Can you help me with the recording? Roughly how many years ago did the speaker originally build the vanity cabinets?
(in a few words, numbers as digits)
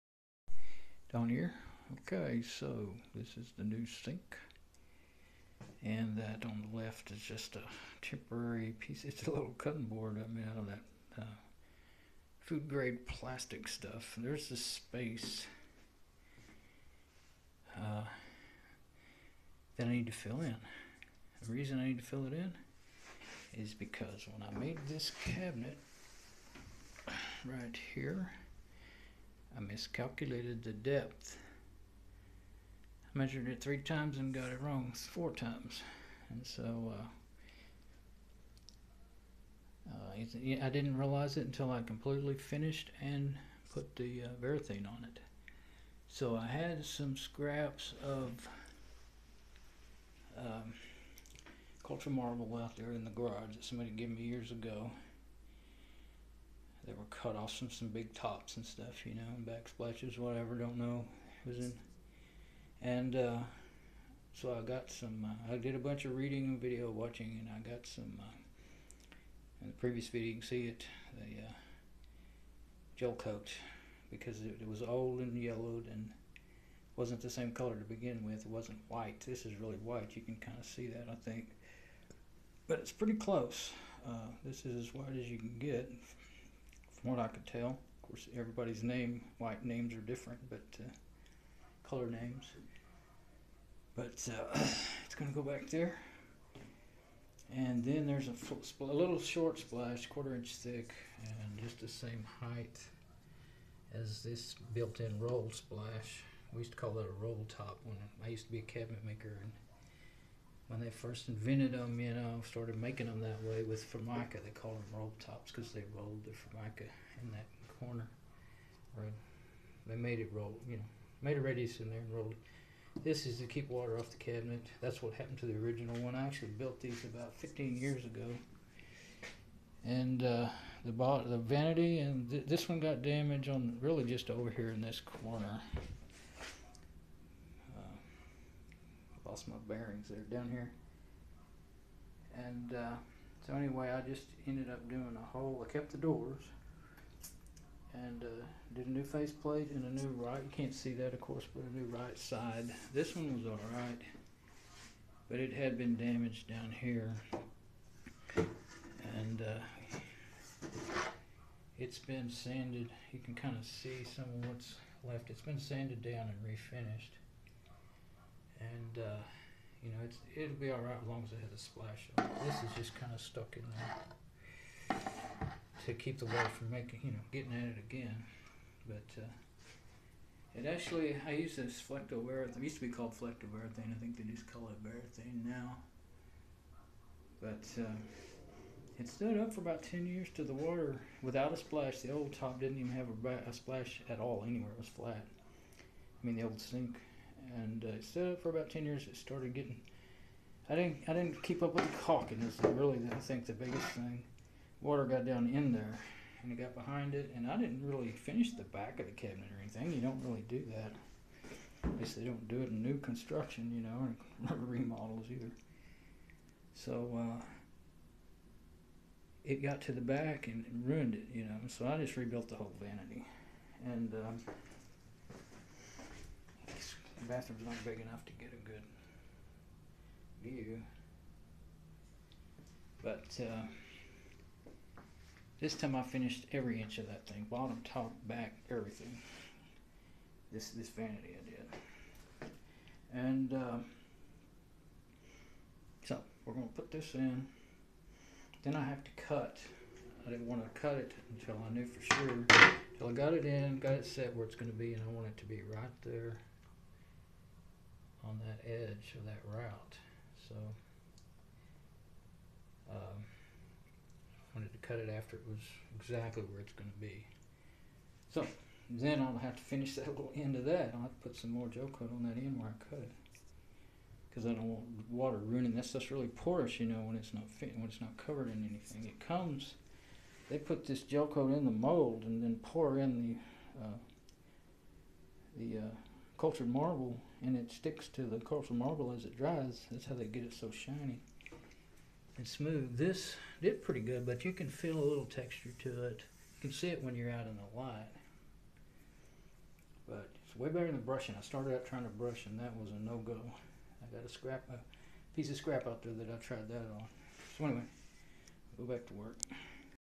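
15.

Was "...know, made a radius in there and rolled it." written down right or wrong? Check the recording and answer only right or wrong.
right.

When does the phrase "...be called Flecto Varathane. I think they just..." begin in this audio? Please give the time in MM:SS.
03:02.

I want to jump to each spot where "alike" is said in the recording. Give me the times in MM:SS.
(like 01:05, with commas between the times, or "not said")
not said.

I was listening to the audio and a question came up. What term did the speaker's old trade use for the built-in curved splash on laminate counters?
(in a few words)
roll tops.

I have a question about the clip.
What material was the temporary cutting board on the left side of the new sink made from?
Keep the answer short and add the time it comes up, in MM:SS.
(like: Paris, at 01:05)
food grade plastic, at 00:12.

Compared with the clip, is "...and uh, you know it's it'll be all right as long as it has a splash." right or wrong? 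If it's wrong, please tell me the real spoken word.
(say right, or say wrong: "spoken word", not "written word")
right.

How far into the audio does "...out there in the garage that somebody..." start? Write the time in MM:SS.
00:52.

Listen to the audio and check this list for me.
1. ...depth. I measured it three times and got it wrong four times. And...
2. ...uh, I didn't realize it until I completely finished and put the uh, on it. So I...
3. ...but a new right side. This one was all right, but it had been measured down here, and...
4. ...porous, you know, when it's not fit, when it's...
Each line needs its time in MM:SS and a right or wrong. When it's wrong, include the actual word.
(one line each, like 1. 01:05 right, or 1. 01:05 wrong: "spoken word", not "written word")
1. 00:30 right
2. 00:39 right
3. 02:31 wrong: "damaged", not "measured"
4. 04:36 right.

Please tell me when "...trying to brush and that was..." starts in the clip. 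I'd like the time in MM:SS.
05:01.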